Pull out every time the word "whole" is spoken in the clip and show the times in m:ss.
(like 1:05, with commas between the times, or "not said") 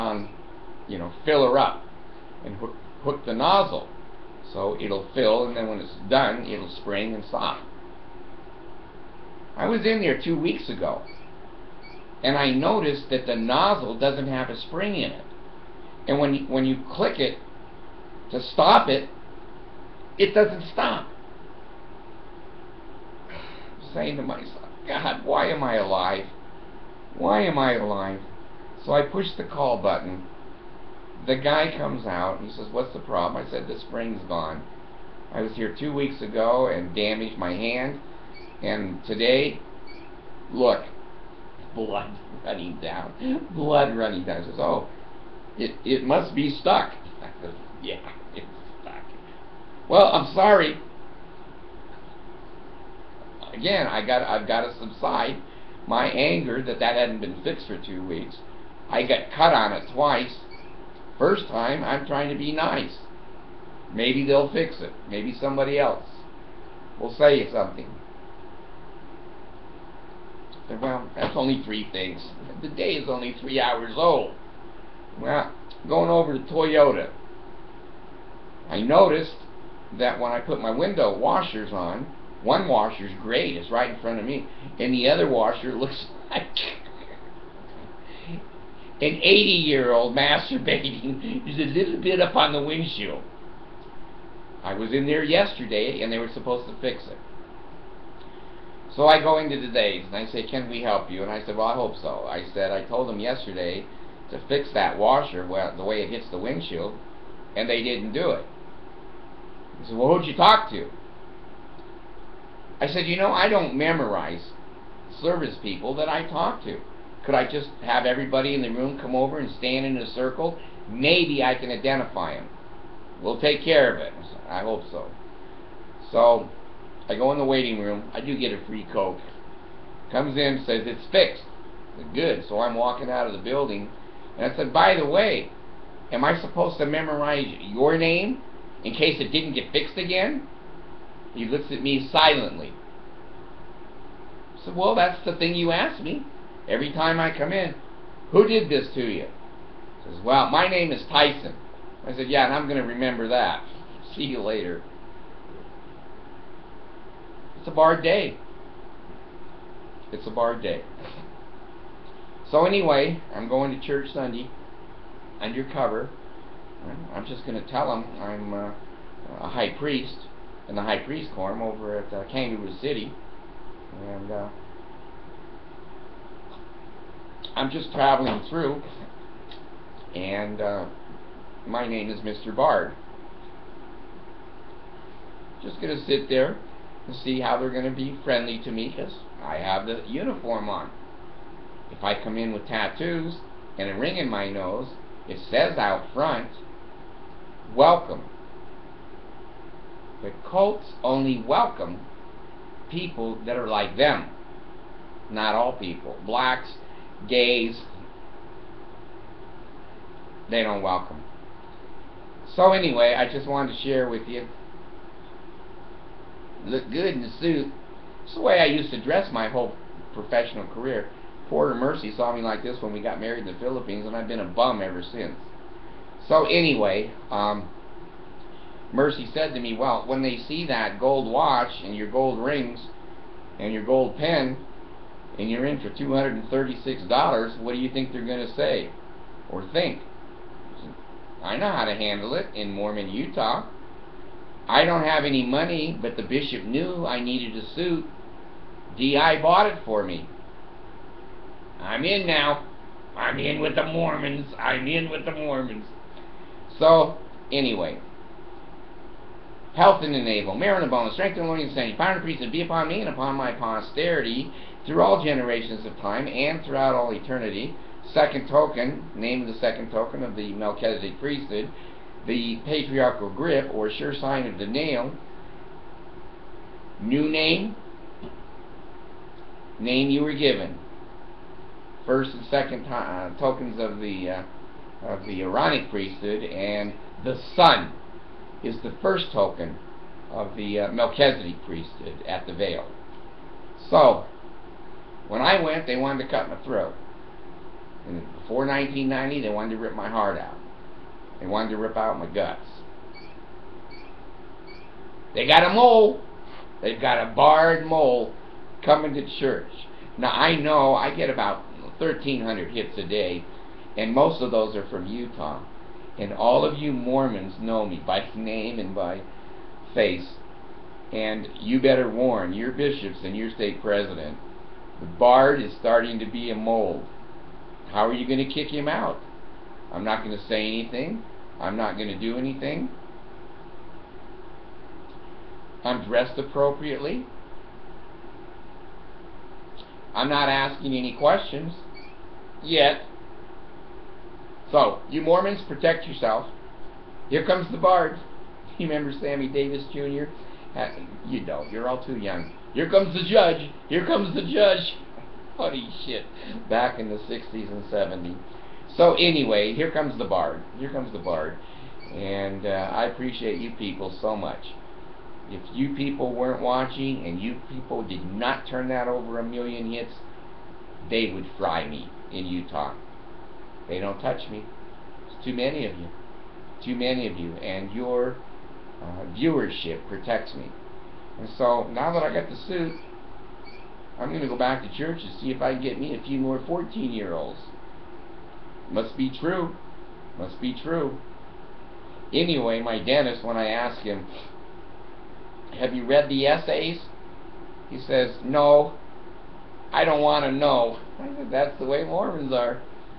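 3:39.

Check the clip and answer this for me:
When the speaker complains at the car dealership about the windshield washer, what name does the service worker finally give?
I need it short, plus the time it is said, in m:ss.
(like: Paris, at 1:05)
Tyson, at 2:31.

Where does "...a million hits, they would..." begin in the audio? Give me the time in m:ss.
6:09.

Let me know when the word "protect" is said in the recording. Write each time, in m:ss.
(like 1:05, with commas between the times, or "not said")
5:45, 6:20.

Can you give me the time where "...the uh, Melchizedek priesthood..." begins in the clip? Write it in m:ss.
4:50.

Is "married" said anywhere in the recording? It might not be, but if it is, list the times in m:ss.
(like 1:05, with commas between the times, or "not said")
3:43.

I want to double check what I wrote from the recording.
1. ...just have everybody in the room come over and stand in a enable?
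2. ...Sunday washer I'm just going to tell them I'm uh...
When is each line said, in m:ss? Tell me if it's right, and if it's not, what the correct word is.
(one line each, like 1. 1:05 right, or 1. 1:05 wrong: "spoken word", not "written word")
1. 1:57 wrong: "circle", not "enable"
2. 2:44 wrong: "undercover", not "washer".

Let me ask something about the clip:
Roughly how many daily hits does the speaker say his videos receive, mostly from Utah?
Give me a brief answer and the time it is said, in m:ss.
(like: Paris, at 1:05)
1,300, at 5:11.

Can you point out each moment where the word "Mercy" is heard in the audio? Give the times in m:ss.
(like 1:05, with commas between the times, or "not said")
3:41, 3:48.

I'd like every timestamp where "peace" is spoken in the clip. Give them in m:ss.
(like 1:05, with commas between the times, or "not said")
4:22.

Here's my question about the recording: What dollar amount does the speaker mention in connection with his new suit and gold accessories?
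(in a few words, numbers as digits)
$236.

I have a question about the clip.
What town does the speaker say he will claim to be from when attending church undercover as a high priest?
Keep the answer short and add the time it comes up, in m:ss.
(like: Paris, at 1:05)
Kangaroo City, at 2:52.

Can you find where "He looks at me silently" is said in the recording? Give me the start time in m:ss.
2:21.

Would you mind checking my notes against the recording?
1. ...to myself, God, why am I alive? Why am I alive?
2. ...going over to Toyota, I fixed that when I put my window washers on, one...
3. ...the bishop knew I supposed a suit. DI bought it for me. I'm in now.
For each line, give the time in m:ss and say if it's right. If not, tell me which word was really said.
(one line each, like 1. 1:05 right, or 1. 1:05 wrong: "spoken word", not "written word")
1. 0:24 right
2. 1:15 wrong: "noticed", not "fixed"
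3. 4:06 wrong: "needed", not "supposed".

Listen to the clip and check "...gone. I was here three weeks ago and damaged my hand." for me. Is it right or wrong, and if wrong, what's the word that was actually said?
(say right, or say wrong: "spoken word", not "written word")
wrong: "two", not "three".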